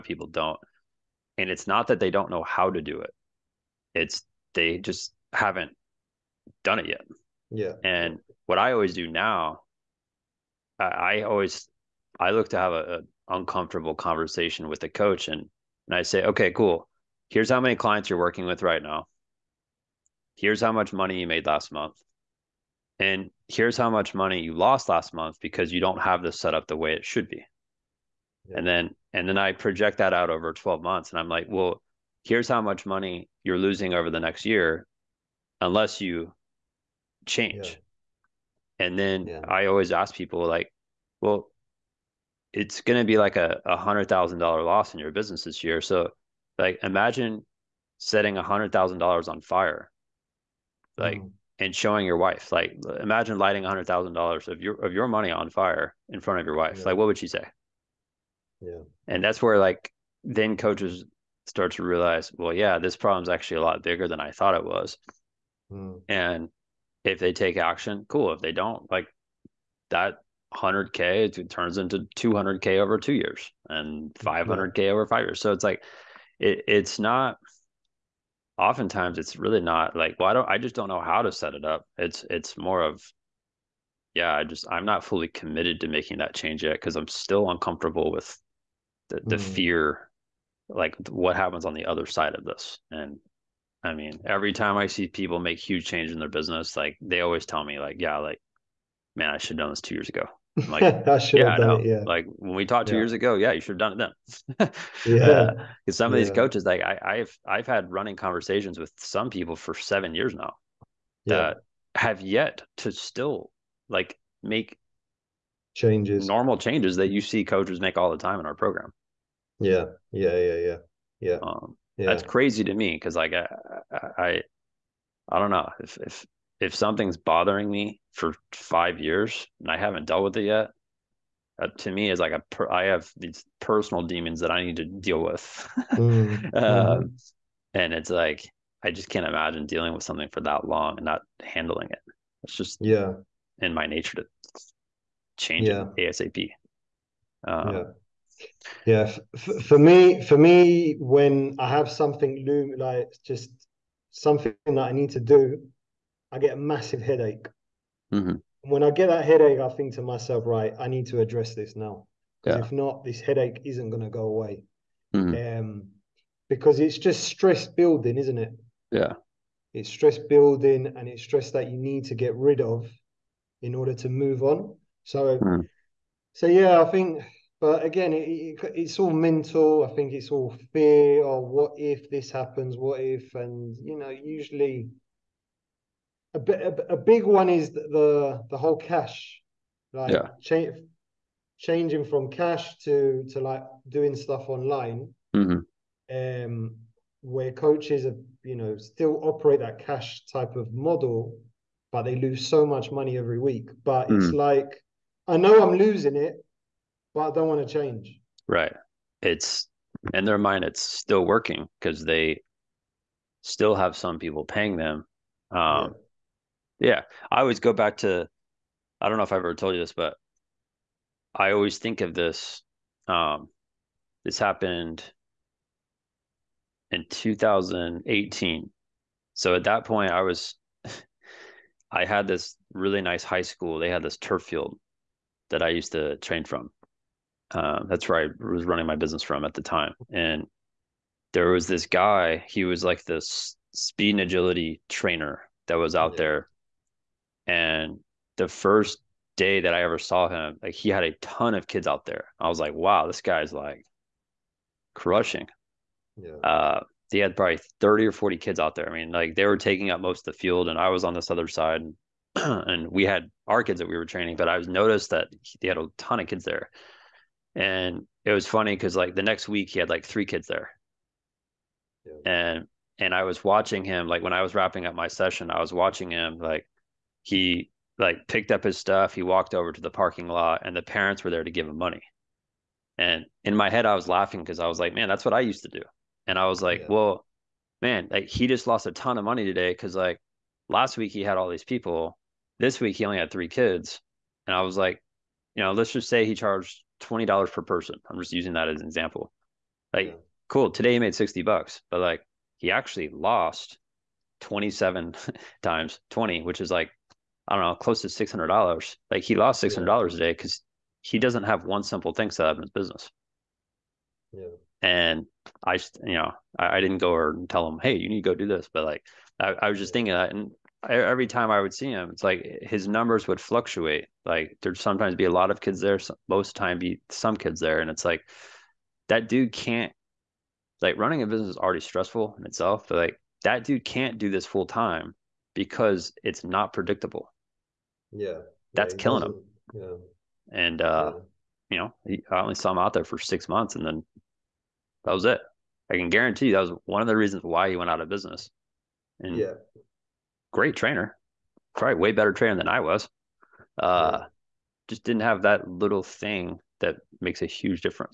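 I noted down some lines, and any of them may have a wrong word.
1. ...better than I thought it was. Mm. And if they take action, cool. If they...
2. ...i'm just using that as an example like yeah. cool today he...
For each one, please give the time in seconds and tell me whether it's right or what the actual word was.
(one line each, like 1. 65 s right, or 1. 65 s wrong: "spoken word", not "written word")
1. 63 s wrong: "bigger", not "better"
2. 298 s right.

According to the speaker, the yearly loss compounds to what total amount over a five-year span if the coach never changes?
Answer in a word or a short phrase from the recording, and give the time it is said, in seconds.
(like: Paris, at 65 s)
500k, at 74 s.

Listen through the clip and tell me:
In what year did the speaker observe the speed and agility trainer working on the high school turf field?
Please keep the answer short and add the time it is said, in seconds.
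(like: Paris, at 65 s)
2018, at 227 s.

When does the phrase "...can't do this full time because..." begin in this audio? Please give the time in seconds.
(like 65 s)
333 s.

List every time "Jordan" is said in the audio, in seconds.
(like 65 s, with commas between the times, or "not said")
not said.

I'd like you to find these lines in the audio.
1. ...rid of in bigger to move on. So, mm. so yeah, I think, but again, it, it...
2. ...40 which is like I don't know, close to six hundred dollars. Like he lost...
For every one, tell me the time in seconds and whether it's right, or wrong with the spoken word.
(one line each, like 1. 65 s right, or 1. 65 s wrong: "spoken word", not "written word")
1. 172 s wrong: "order", not "bigger"
2. 306 s wrong: "20", not "40".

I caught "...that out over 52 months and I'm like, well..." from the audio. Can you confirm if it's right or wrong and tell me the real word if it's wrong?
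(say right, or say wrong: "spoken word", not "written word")
wrong: "12", not "52".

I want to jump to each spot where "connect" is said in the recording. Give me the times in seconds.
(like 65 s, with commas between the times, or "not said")
not said.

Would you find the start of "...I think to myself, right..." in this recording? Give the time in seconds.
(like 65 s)
159 s.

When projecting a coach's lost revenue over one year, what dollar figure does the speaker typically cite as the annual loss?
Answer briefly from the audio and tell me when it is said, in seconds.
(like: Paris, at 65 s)
$100,000, at 43 s.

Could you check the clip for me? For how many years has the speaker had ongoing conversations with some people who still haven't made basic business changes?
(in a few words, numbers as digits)
7.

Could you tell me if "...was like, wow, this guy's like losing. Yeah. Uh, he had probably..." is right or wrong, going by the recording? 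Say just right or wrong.
wrong.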